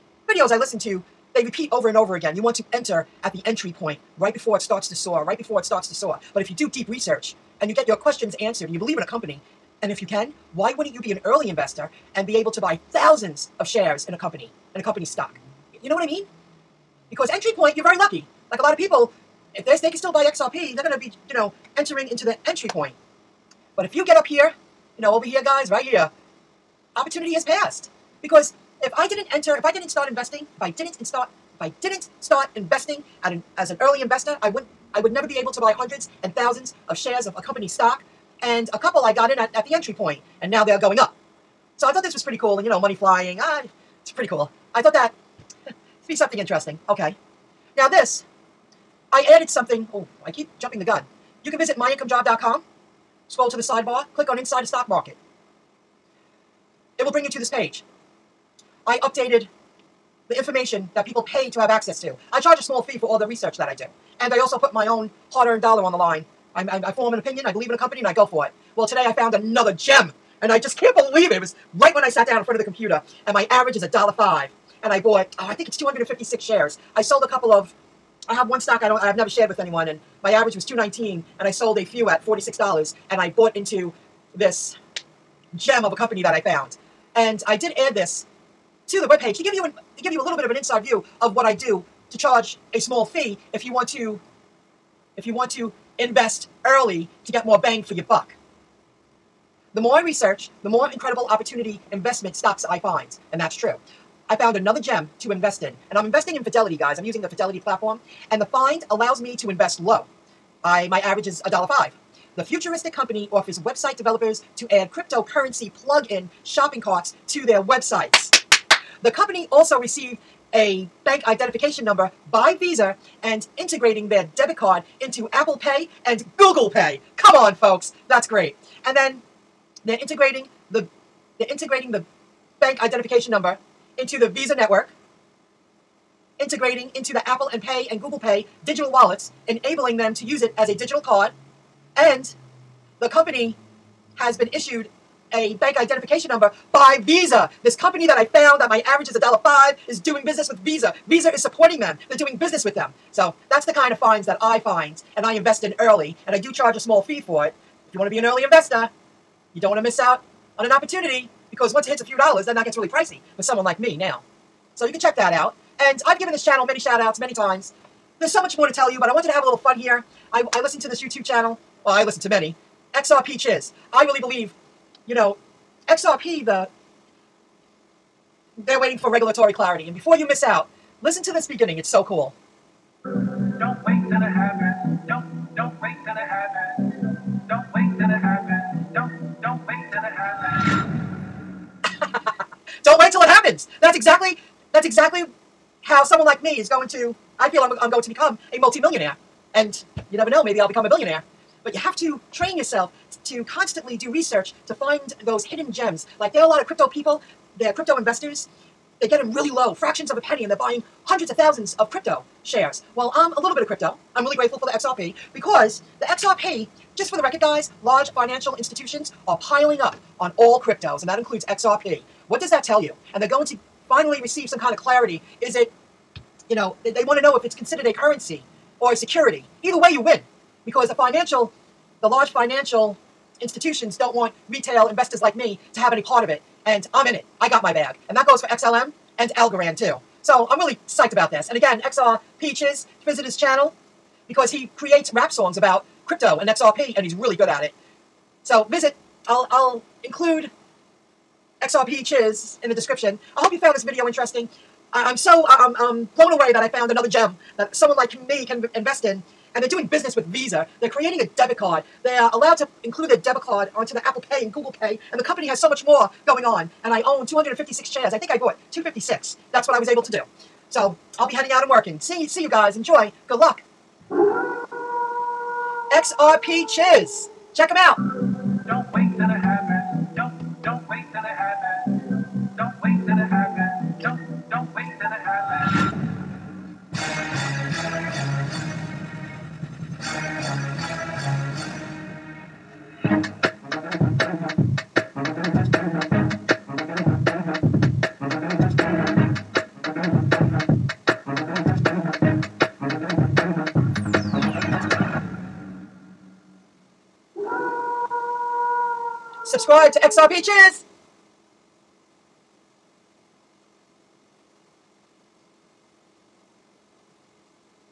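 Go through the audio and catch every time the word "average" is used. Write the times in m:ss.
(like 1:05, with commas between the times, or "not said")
1:13, 1:20, 1:50, 2:28.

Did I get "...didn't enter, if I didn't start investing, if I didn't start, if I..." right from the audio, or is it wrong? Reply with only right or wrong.
right.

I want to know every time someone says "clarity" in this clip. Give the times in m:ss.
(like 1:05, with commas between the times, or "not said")
2:59, 3:44.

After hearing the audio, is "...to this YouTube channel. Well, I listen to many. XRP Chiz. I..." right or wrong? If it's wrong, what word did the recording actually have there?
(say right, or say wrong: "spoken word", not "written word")
right.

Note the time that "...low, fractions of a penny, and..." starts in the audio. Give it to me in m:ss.
3:29.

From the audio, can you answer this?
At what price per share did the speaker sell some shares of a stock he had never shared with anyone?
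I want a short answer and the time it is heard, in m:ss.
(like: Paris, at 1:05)
$46, at 1:22.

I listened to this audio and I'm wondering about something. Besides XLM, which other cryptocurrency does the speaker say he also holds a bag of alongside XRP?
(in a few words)
Algorand.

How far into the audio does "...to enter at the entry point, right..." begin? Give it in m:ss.
0:02.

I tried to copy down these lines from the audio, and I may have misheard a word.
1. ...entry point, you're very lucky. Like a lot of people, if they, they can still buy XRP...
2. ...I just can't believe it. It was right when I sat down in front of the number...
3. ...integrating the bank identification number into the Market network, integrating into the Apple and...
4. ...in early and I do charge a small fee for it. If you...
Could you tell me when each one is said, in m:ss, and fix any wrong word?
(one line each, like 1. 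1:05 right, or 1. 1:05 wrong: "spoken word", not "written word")
1. 0:17 right
2. 1:10 wrong: "computer", not "number"
3. 2:11 wrong: "Visa", not "Market"
4. 2:35 right.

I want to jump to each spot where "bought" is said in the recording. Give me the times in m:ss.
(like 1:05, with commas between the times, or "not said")
1:14, 1:23, 4:28.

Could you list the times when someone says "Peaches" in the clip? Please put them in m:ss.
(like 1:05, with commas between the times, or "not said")
4:02, 5:10.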